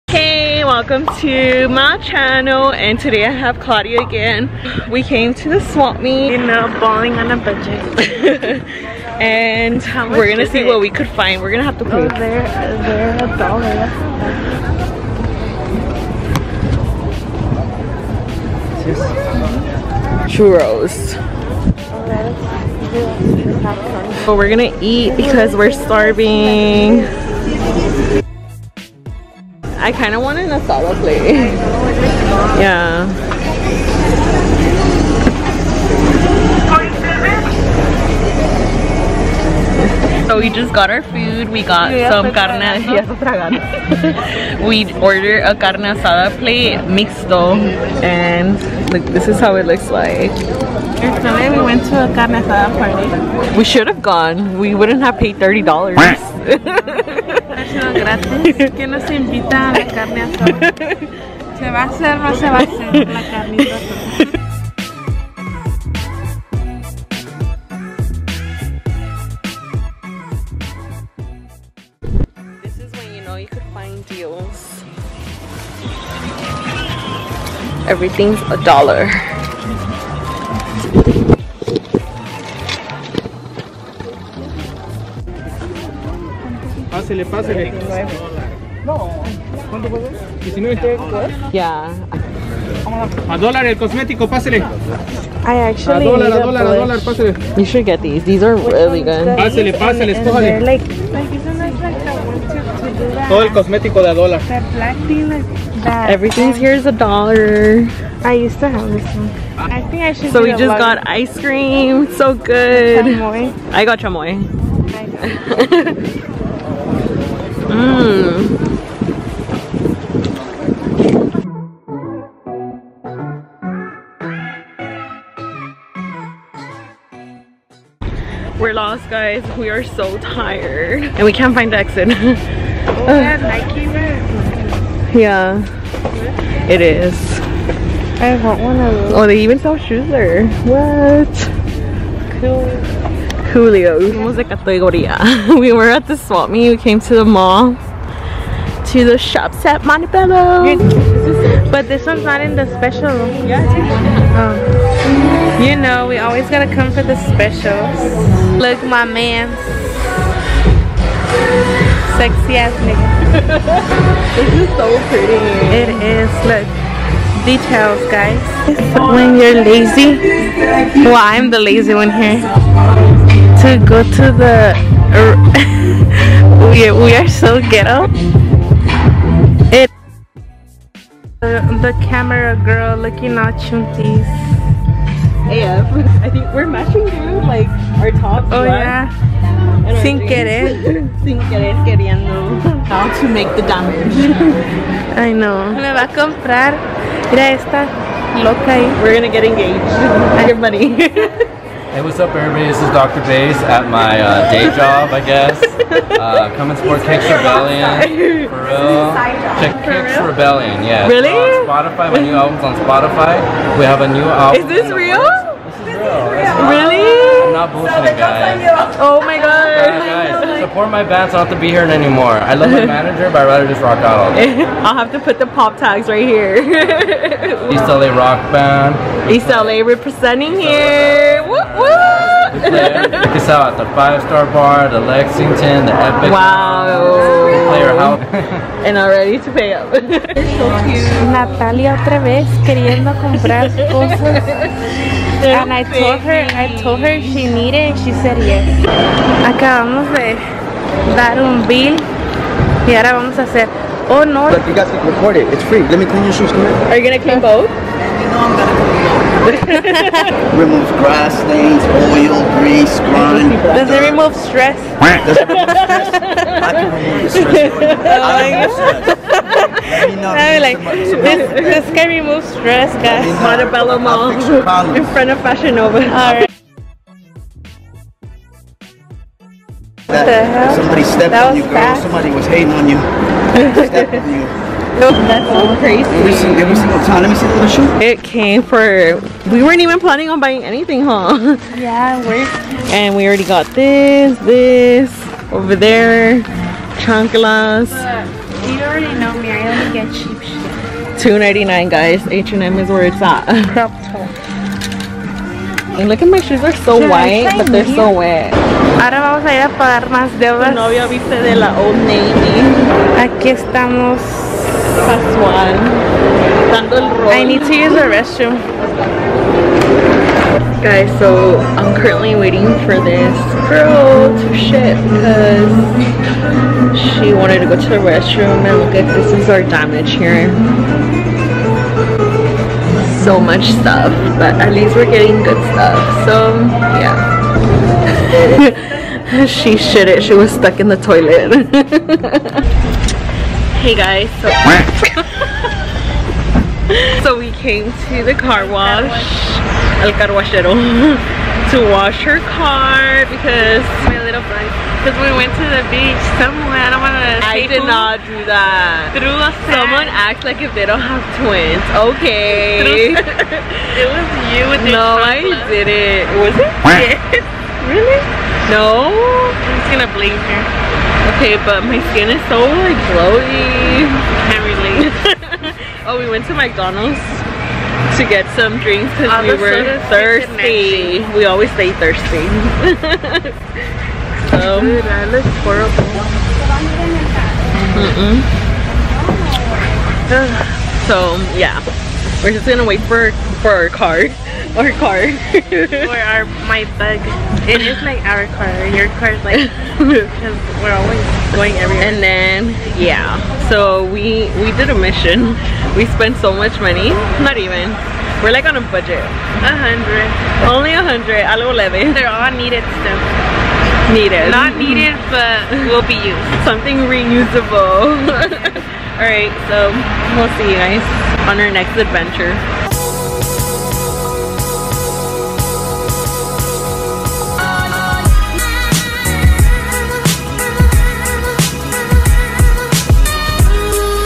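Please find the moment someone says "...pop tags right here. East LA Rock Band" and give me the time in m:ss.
3:45.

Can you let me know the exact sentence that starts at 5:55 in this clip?
Because we went to the beach somewhere, I don't want to I did not do that.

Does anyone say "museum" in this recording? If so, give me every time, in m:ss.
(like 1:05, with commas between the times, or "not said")
not said.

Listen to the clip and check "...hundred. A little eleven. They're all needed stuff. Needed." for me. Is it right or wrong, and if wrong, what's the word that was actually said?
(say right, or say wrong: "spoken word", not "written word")
right.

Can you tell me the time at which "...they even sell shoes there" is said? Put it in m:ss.
2:19.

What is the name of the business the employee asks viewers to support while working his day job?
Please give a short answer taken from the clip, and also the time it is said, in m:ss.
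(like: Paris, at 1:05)
Kicks Rebellion, at 3:27.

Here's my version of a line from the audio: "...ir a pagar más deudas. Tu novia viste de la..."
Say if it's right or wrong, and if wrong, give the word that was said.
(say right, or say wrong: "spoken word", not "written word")
right.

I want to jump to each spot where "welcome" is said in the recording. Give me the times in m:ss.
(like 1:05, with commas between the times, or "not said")
0:00.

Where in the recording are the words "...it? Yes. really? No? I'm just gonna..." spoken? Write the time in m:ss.
6:06.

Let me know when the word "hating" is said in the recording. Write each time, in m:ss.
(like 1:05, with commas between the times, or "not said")
4:42.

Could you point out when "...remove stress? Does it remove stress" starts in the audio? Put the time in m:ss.
4:24.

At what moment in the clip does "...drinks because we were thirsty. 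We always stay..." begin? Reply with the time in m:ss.
6:18.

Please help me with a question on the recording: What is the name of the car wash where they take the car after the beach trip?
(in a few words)
El Carwashero.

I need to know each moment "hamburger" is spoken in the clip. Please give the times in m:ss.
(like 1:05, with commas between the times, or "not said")
not said.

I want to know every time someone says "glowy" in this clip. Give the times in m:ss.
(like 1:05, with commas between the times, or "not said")
6:13.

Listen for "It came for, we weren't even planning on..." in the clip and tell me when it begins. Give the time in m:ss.
4:48.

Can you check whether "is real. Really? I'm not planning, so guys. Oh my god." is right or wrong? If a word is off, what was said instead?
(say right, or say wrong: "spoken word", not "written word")
wrong: "bullshitting", not "planning".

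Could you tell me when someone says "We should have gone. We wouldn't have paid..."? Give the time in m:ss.
0:53.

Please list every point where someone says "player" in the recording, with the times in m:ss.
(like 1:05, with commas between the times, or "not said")
3:52, 3:57.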